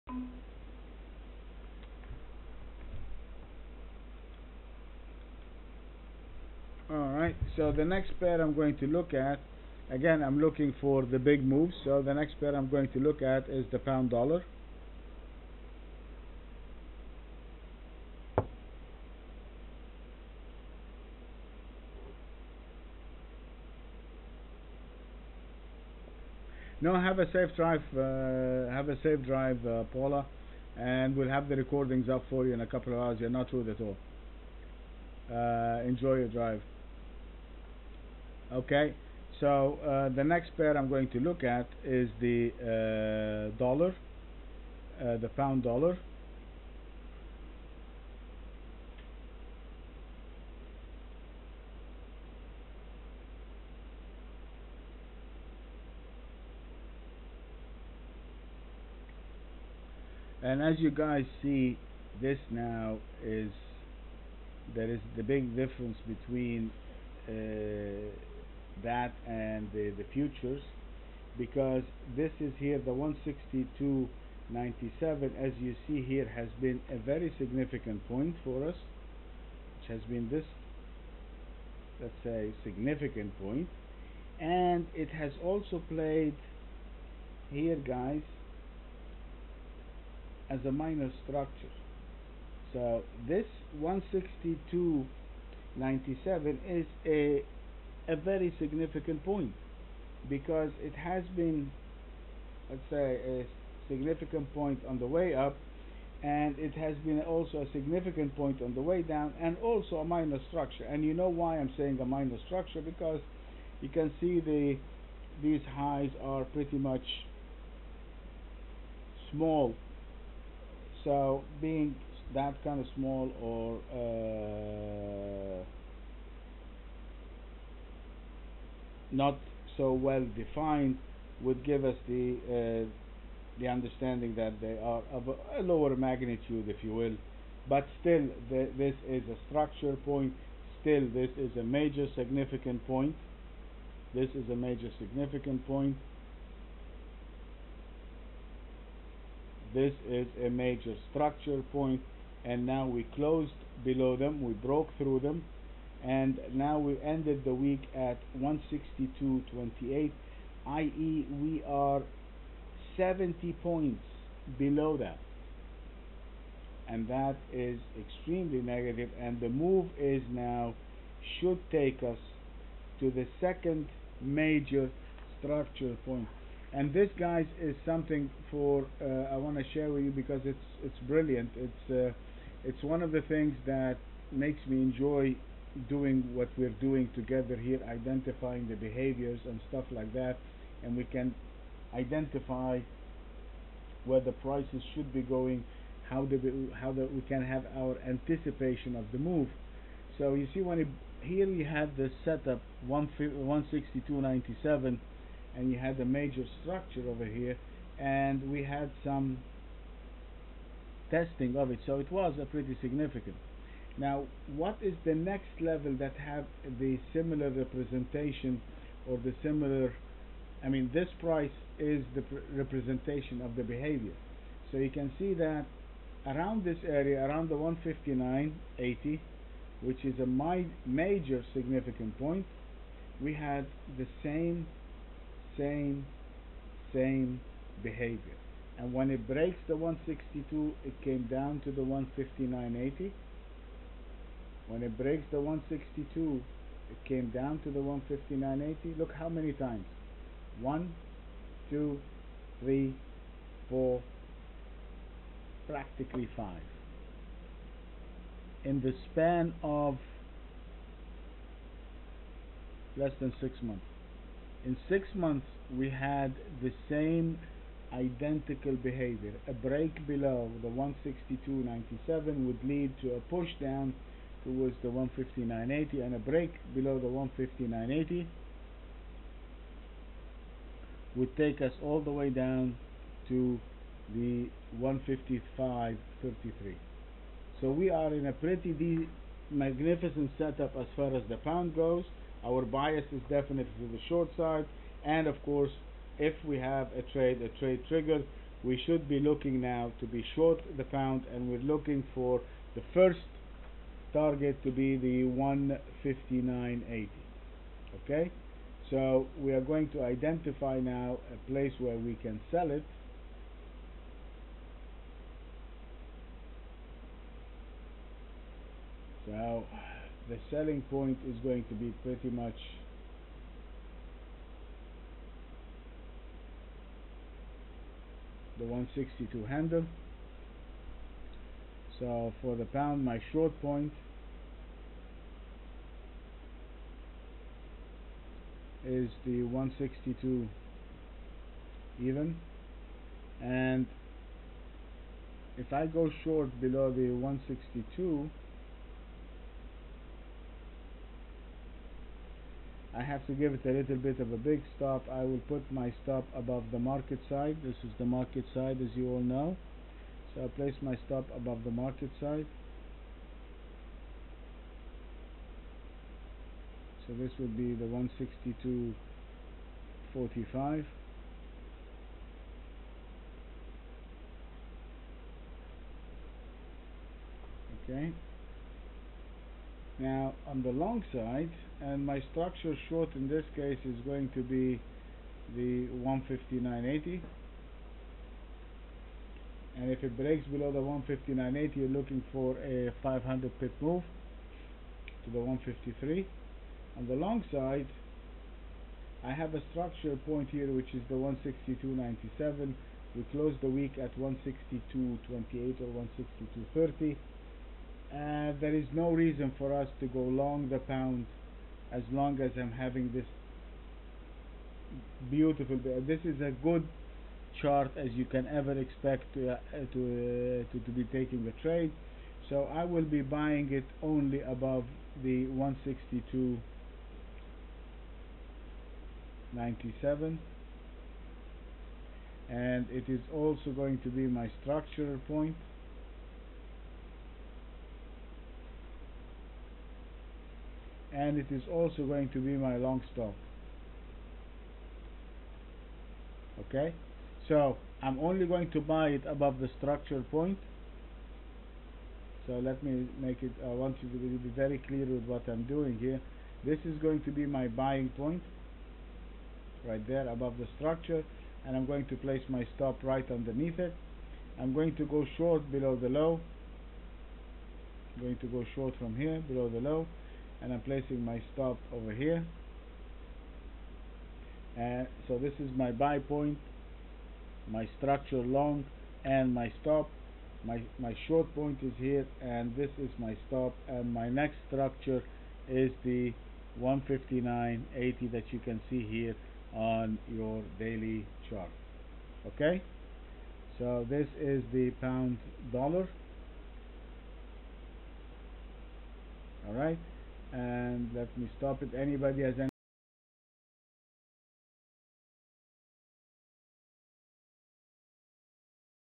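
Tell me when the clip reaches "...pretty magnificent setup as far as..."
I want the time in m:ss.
4:48.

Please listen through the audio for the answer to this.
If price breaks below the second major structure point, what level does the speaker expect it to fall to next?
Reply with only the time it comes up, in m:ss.
4:44.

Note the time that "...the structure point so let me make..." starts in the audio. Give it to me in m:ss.
7:29.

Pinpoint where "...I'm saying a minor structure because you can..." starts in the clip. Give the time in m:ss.
1:51.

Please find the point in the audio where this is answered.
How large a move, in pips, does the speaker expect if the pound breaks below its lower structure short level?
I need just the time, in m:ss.
6:33.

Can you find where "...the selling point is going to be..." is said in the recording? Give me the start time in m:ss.
5:20.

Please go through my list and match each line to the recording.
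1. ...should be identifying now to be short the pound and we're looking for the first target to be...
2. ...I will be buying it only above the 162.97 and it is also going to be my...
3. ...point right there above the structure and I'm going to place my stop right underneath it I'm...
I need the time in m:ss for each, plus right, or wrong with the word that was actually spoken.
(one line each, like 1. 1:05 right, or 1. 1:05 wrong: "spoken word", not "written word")
1. 4:58 wrong: "looking", not "identifying"
2. 7:02 right
3. 7:38 right.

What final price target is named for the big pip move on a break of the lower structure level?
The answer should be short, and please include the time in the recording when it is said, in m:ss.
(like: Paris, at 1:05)
153, at 6:35.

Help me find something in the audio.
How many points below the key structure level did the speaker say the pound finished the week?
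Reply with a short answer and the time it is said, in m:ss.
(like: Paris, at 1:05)
70, at 2:42.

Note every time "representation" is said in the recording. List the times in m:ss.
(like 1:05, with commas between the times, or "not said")
3:37, 3:42.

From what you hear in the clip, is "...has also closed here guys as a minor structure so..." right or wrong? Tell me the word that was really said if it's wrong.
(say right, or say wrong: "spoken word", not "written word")
wrong: "played", not "closed".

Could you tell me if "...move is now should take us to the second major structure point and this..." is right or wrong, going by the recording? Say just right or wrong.
right.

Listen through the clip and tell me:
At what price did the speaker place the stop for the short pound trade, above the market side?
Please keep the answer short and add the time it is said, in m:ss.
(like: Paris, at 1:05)
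162.45, at 6:07.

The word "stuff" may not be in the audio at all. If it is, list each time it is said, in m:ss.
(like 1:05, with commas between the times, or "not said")
3:09.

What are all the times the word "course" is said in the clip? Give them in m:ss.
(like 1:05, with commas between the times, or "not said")
4:55.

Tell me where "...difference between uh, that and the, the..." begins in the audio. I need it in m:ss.
1:05.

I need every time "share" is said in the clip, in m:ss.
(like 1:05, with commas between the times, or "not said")
2:59.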